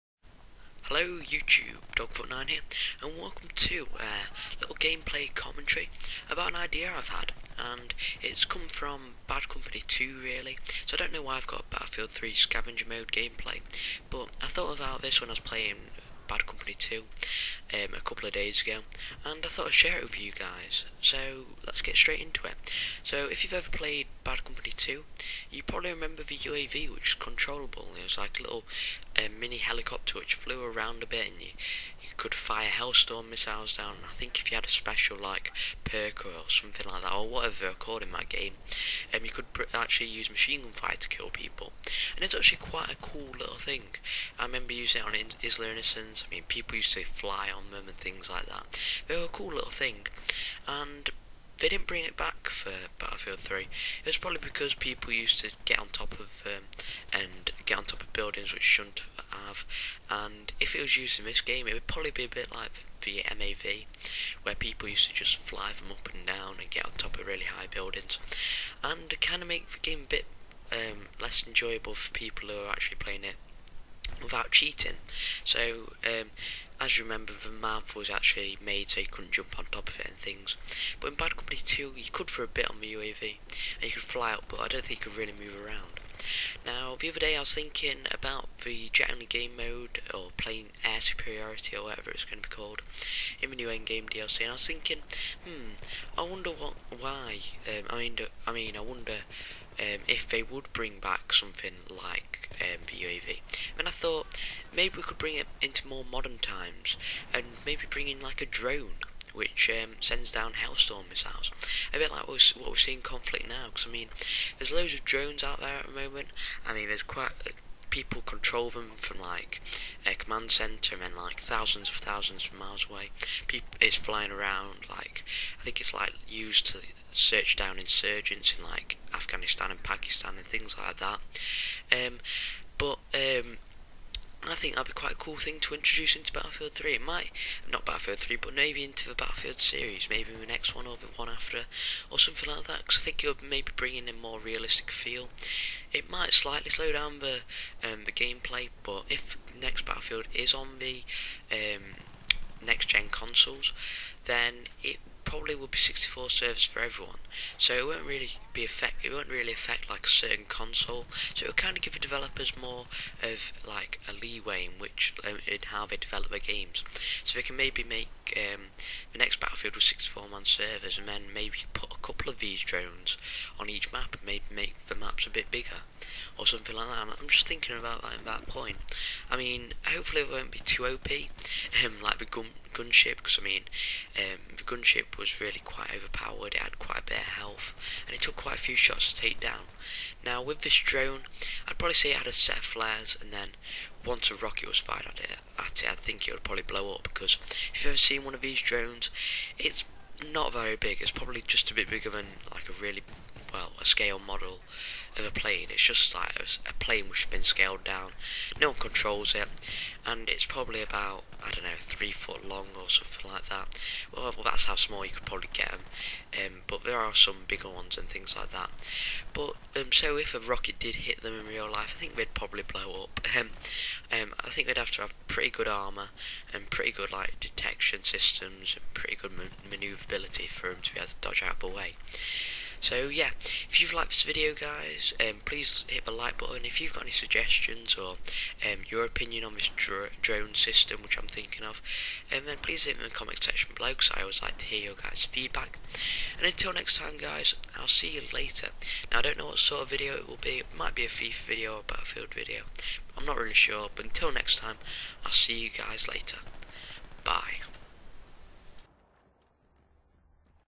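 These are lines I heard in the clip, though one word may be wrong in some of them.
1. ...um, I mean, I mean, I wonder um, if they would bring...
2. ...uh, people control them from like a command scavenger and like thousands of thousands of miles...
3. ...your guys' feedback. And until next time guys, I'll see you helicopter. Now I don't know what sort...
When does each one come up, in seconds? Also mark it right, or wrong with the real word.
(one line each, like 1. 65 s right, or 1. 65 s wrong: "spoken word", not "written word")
1. 97 s right
2. 117 s wrong: "center", not "scavenger"
3. 244 s wrong: "later", not "helicopter".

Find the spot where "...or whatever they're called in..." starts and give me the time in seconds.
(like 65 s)
37 s.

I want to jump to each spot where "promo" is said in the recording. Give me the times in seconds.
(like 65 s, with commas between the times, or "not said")
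not said.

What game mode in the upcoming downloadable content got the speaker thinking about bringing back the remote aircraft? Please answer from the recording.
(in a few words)
air superiority.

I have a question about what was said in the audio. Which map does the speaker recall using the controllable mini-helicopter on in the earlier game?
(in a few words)
Isla Inocentes.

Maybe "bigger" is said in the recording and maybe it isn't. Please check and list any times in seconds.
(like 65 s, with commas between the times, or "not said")
175 s, 201 s, 217 s.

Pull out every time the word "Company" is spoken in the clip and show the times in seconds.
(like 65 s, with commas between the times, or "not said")
9 s, 16 s, 24 s, 81 s.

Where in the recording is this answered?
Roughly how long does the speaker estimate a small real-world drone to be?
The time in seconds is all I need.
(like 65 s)
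211 s.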